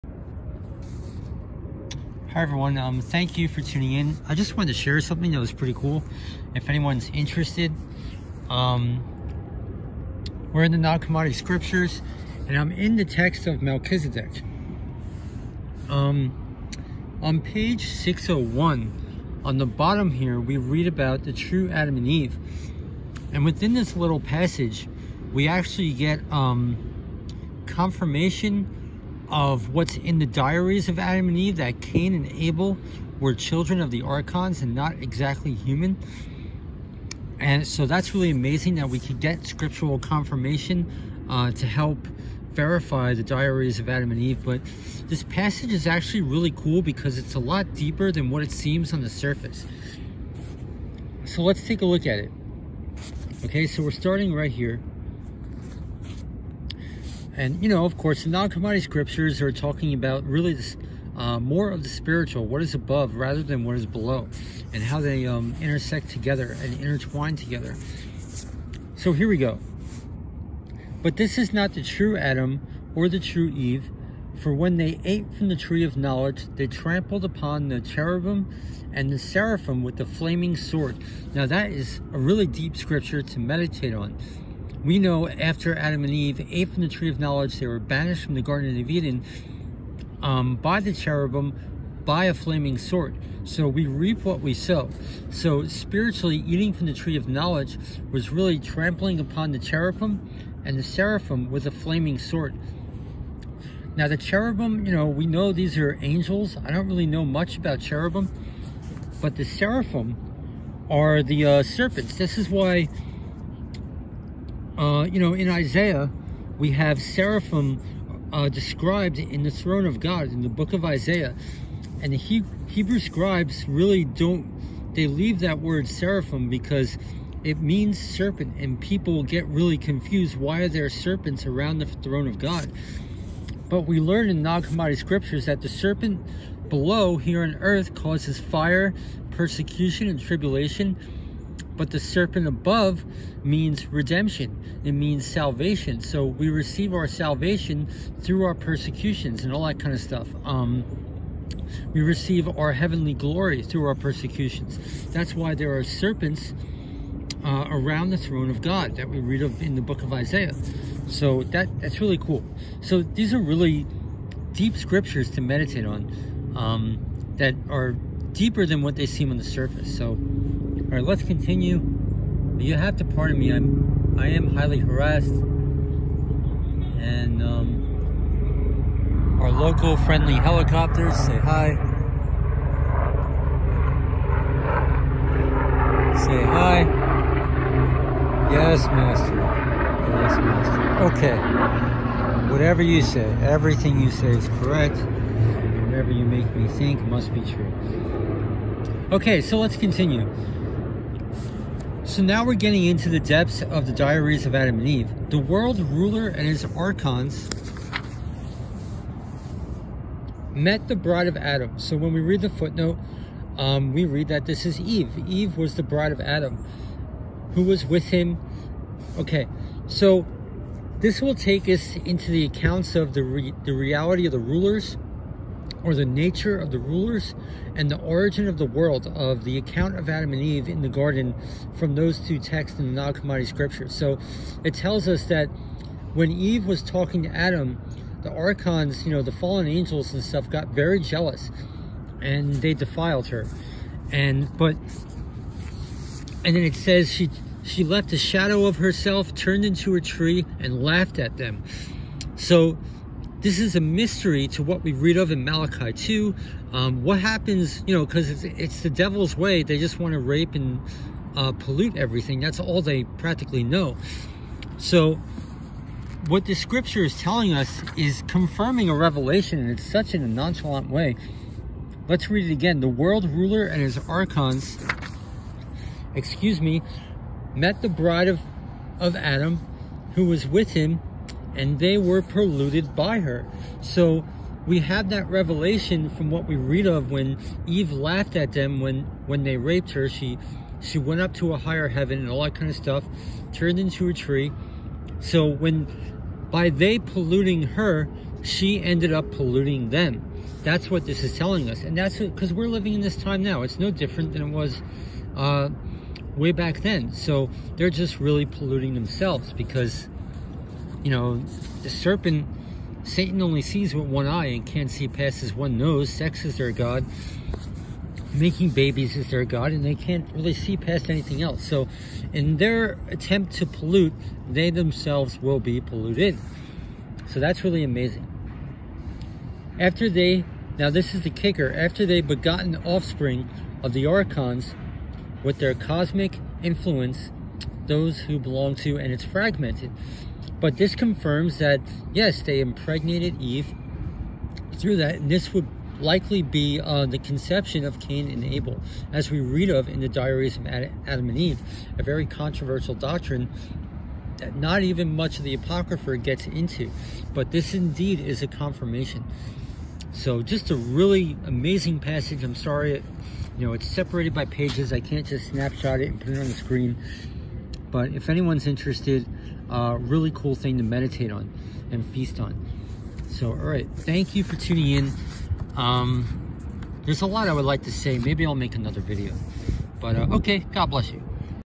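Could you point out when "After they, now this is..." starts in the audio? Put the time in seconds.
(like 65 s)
329 s.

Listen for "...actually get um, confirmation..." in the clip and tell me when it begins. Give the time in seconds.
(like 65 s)
25 s.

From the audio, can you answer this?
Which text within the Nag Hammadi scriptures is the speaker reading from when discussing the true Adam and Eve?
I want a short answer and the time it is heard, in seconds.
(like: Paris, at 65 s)
Melchizedek, at 13 s.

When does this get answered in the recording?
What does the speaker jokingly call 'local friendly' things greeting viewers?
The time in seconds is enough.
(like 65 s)
180 s.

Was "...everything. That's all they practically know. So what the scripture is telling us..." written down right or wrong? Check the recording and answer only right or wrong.
right.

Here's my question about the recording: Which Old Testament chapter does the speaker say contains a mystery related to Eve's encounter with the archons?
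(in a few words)
Malachi 2.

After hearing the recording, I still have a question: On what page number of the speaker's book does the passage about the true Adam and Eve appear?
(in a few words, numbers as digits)
601.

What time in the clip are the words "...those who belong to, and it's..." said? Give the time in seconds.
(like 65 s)
337 s.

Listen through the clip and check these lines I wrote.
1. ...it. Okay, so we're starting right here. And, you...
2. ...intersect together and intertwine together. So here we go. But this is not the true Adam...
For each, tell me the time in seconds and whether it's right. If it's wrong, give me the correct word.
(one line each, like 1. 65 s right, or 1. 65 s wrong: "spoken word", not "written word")
1. 52 s right
2. 65 s right.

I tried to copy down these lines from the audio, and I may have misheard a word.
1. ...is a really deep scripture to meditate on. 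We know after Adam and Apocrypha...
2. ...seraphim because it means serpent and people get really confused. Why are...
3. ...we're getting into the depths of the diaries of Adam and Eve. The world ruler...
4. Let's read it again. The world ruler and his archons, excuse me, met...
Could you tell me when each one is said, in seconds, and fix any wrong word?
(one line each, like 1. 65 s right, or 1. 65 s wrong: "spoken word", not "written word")
1. 81 s wrong: "Eve", not "Apocrypha"
2. 125 s right
3. 202 s right
4. 272 s right.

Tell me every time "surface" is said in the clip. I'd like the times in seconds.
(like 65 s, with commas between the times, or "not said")
49 s, 169 s.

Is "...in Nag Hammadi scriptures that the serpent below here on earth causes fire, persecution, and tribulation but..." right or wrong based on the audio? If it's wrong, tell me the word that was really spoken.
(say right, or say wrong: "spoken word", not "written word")
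right.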